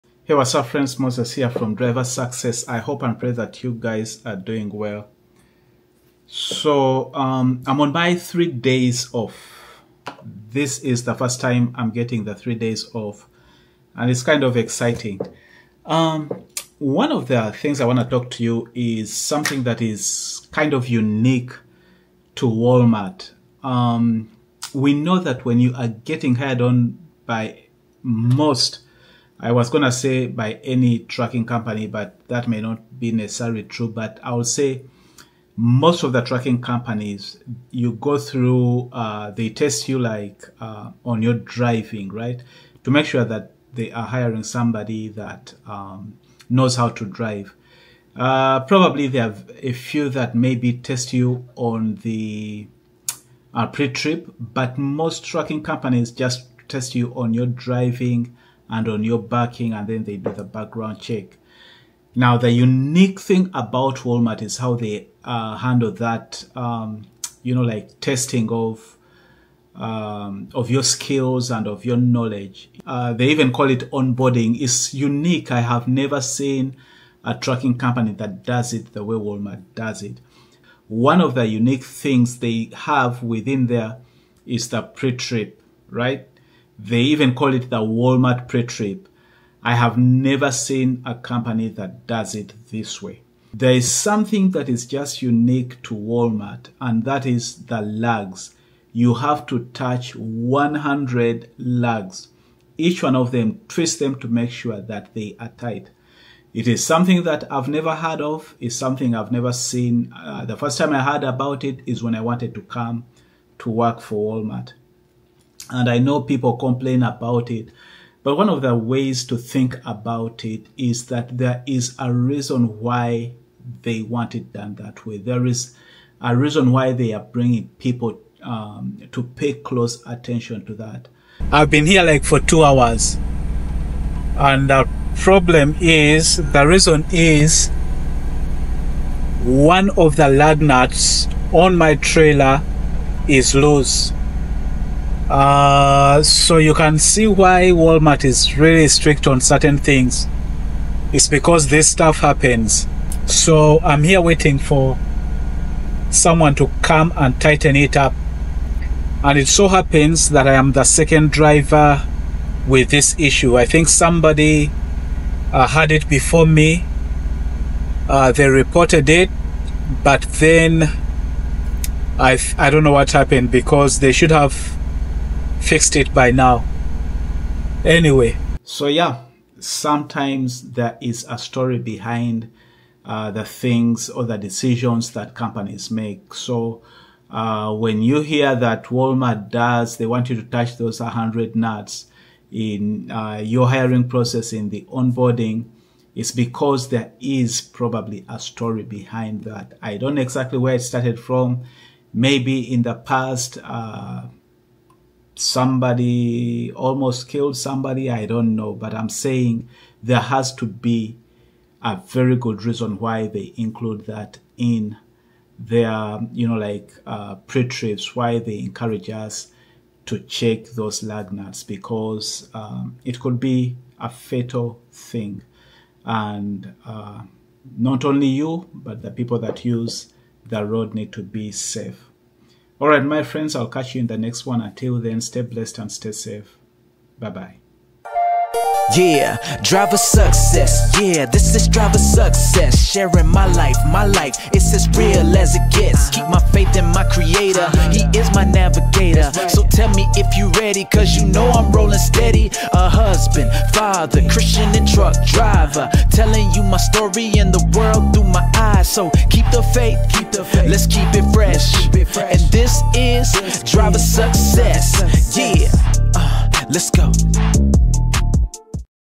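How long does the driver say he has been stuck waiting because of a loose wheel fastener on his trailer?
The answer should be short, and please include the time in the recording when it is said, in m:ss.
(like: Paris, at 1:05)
two hours, at 2:12.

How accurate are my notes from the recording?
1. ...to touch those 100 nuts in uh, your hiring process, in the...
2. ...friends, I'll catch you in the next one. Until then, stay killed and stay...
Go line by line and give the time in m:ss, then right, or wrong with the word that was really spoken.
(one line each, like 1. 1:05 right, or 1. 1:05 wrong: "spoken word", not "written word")
1. 3:10 right
2. 3:53 wrong: "blessed", not "killed".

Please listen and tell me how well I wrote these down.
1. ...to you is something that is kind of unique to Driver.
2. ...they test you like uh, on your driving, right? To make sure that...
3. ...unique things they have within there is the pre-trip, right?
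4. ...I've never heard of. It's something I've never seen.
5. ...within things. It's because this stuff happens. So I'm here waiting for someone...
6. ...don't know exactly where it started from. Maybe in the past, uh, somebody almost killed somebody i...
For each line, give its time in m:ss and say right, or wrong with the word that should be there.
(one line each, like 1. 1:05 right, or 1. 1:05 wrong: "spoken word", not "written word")
1. 0:18 wrong: "Walmart", not "Driver"
2. 0:39 right
3. 1:21 right
4. 1:47 right
5. 2:29 wrong: "certain", not "within"
6. 3:19 right.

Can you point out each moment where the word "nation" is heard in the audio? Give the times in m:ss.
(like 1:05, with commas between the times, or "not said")
not said.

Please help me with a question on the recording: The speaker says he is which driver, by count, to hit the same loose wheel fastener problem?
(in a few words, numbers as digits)
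second.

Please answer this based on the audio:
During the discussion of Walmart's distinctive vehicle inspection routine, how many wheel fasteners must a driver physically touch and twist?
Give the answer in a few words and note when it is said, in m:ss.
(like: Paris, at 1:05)
100, at 1:40.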